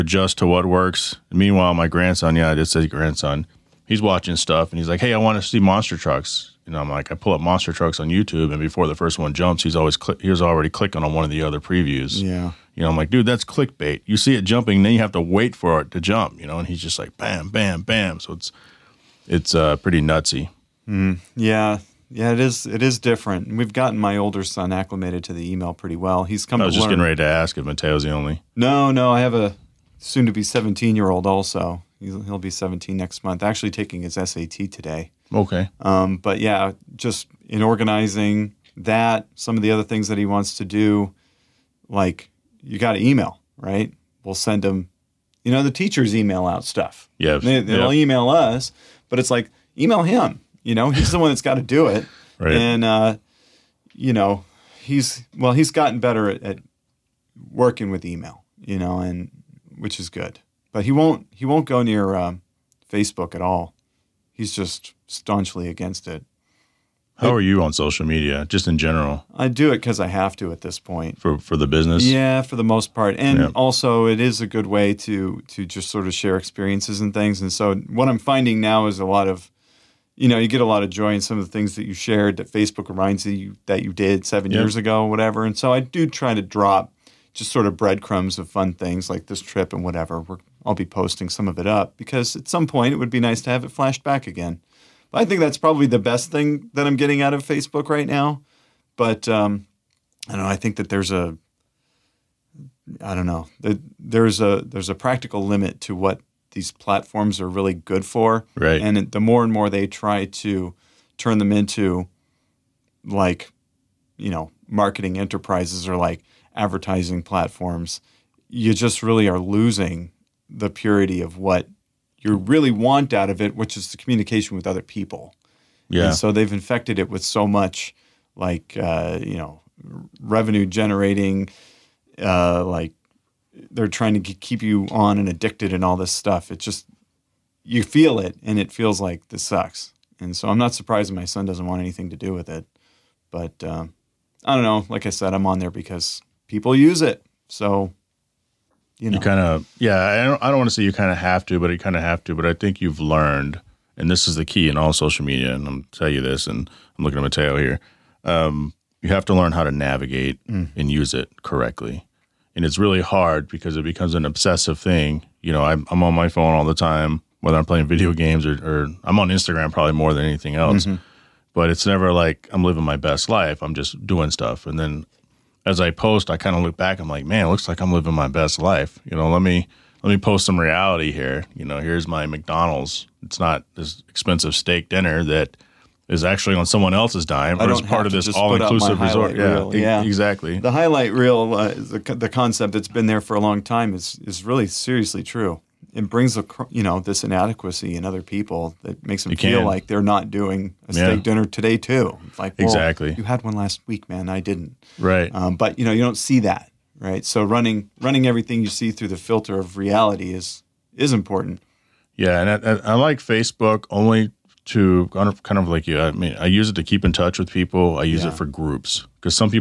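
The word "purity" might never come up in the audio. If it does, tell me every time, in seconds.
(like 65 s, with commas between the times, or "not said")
120 s.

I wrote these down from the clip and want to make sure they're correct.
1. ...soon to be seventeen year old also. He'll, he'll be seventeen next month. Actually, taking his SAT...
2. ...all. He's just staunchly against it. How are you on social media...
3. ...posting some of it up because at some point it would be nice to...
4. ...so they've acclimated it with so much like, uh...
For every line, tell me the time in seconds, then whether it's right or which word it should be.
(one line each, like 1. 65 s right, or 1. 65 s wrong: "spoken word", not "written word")
1. 29 s right
2. 63 s right
3. 90 s right
4. 126 s wrong: "infected", not "acclimated".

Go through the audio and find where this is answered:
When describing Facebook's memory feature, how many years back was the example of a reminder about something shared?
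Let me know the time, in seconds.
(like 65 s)
84 s.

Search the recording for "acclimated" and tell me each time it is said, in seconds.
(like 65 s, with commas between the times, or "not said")
24 s.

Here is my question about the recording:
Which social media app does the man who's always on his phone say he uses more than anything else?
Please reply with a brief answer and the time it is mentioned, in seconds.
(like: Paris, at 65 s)
Instagram, at 169 s.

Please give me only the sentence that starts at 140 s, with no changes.
And so I'm not surprised my son doesn't want anything to do with it.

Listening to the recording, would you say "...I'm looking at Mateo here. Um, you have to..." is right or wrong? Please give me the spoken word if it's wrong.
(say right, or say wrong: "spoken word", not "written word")
right.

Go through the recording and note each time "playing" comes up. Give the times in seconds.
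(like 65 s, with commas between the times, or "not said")
167 s.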